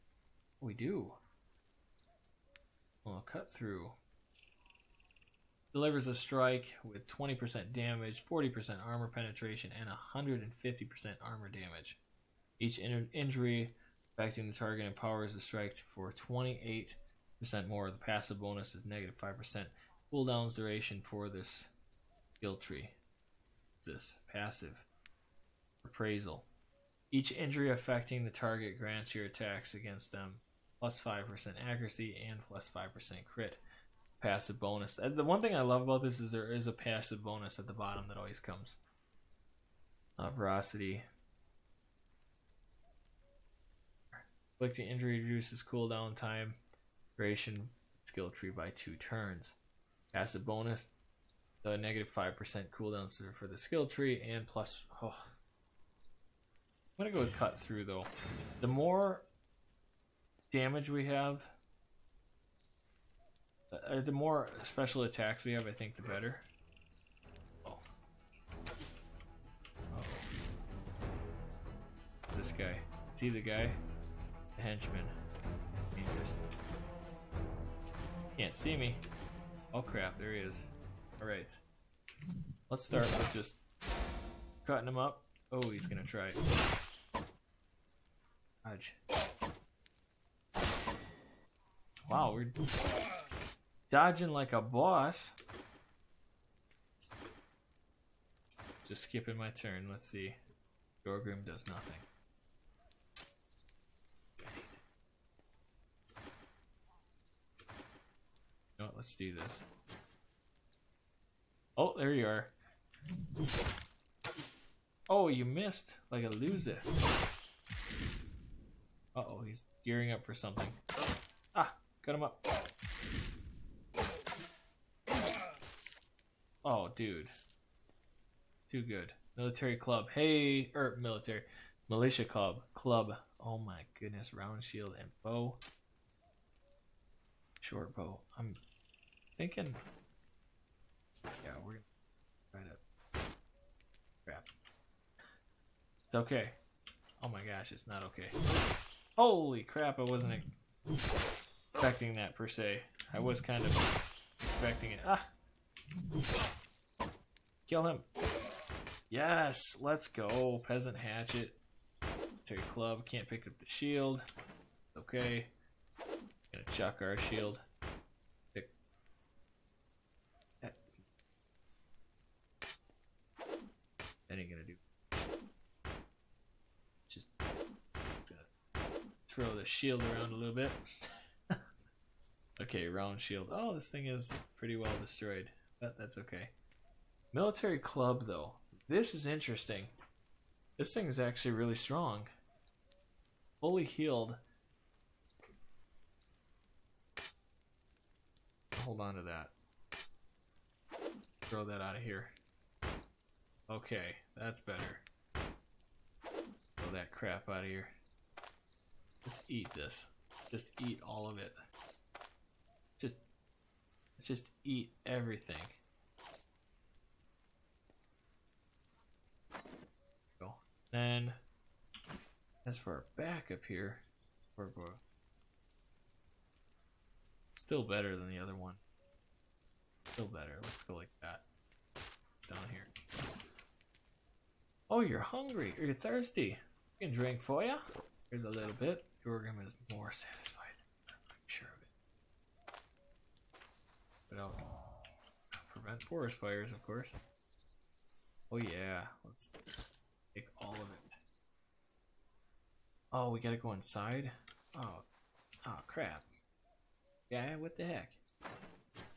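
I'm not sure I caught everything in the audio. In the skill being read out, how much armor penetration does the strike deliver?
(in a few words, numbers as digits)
40%.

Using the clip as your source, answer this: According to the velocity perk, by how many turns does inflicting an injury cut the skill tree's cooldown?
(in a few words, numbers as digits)
2.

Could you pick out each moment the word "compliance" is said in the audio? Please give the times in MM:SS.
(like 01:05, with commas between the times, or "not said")
not said.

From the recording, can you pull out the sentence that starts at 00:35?
The one thing I love about this is there is a passive bonus at the bottom that always comes.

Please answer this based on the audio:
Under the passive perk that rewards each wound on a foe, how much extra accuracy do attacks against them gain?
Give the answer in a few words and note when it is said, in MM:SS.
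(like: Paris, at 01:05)
5%, at 00:30.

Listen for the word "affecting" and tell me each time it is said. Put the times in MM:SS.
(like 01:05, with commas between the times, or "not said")
00:14, 00:27.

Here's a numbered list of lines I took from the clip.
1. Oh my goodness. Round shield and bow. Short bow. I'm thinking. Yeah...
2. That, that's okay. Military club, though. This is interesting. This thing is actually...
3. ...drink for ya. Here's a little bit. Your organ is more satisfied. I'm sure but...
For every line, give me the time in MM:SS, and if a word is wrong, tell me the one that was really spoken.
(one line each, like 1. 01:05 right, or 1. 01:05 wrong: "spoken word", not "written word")
1. 02:13 right
2. 03:05 right
3. 03:57 right.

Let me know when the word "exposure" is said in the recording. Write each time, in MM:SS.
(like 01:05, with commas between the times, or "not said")
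not said.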